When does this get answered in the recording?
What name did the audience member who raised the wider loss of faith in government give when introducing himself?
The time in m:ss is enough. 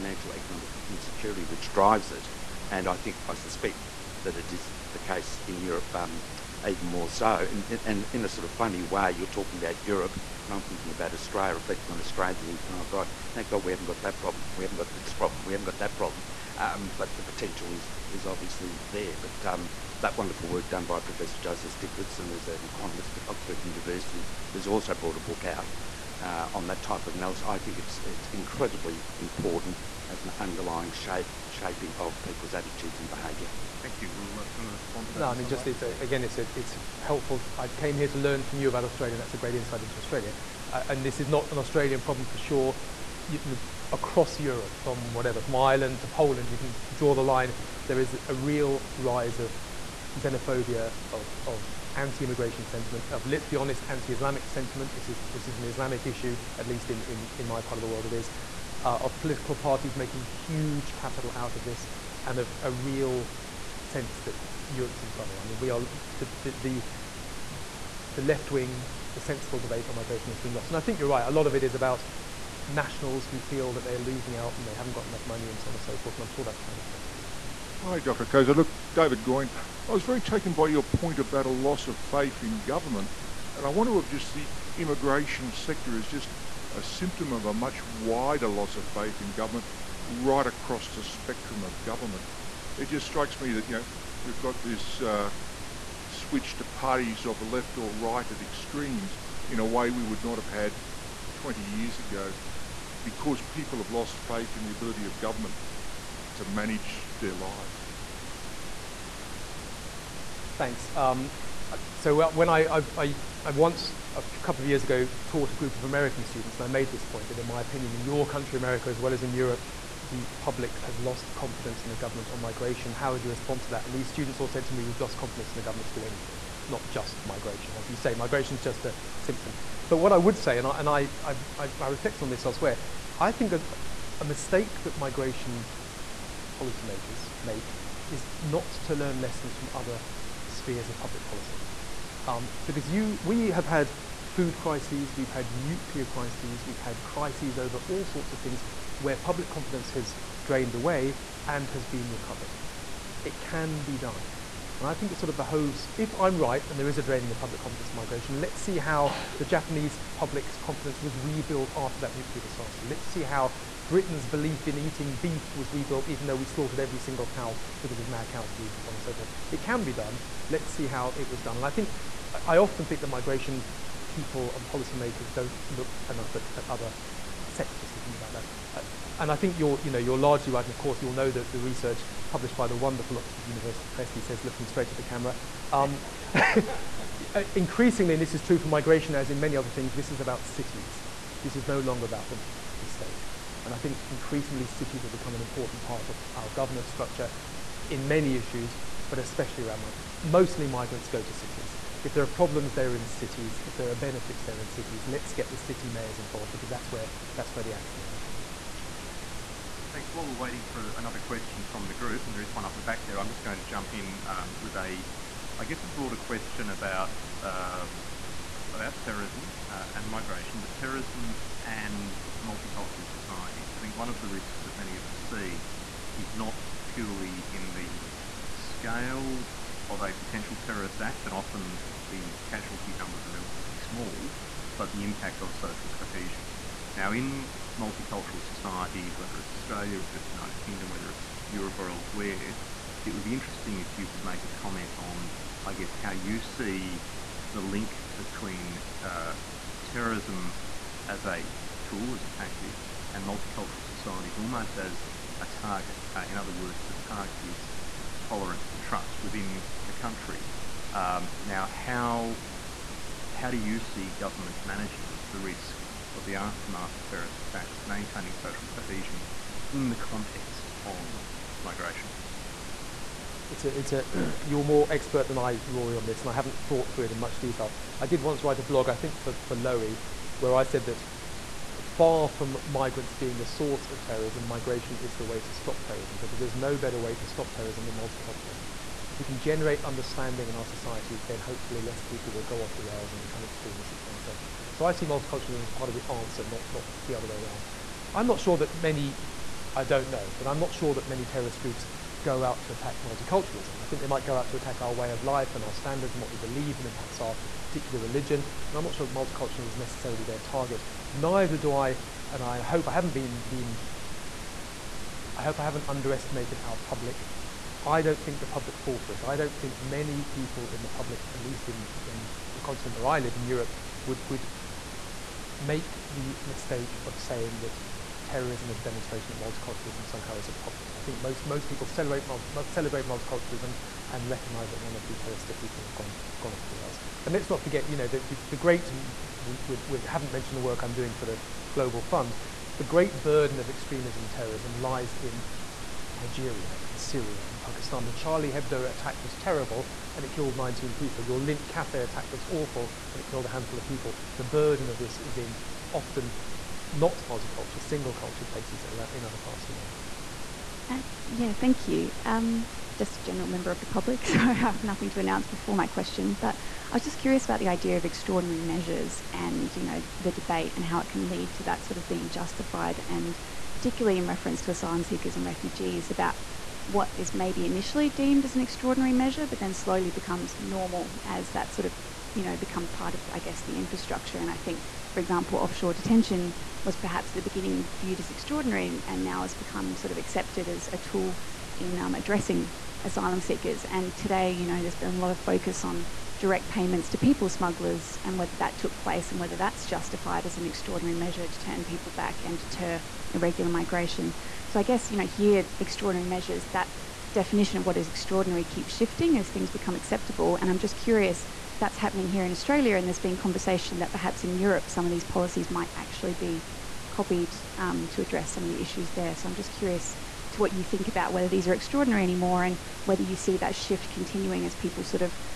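1:18.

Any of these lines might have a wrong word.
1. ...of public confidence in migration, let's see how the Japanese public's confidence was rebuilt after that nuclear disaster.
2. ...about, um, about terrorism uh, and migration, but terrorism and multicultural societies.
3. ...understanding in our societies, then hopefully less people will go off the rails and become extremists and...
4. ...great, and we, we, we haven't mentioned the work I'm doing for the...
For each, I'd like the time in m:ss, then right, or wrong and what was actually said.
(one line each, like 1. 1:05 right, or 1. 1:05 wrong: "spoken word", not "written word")
1. 2:37 right
2. 3:36 right
3. 4:49 right
4. 5:38 right.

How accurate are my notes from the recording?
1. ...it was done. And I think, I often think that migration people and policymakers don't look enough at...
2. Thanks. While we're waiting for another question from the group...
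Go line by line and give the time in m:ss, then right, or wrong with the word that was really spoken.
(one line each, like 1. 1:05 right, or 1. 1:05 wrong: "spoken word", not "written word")
1. 2:51 right
2. 3:29 right.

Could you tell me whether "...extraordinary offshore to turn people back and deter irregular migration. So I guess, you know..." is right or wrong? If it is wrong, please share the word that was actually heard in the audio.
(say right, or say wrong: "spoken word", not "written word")
wrong: "measure", not "offshore".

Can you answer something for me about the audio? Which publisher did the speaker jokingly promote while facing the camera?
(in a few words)
Oxford University Press.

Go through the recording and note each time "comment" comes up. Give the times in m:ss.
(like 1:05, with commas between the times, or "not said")
4:04.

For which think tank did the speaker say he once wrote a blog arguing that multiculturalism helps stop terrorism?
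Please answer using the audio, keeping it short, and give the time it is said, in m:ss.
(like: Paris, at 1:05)
Lowy, at 4:39.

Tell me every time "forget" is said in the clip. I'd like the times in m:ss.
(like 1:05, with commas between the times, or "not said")
5:37.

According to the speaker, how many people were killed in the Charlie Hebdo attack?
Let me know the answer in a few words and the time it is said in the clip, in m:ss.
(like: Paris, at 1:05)
19, at 5:50.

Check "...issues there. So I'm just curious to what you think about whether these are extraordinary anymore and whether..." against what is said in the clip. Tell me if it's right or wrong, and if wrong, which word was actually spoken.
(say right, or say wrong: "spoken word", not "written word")
right.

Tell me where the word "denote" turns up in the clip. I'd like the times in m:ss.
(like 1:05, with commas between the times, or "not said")
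not said.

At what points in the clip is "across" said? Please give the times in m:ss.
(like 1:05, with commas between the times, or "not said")
0:43, 1:30.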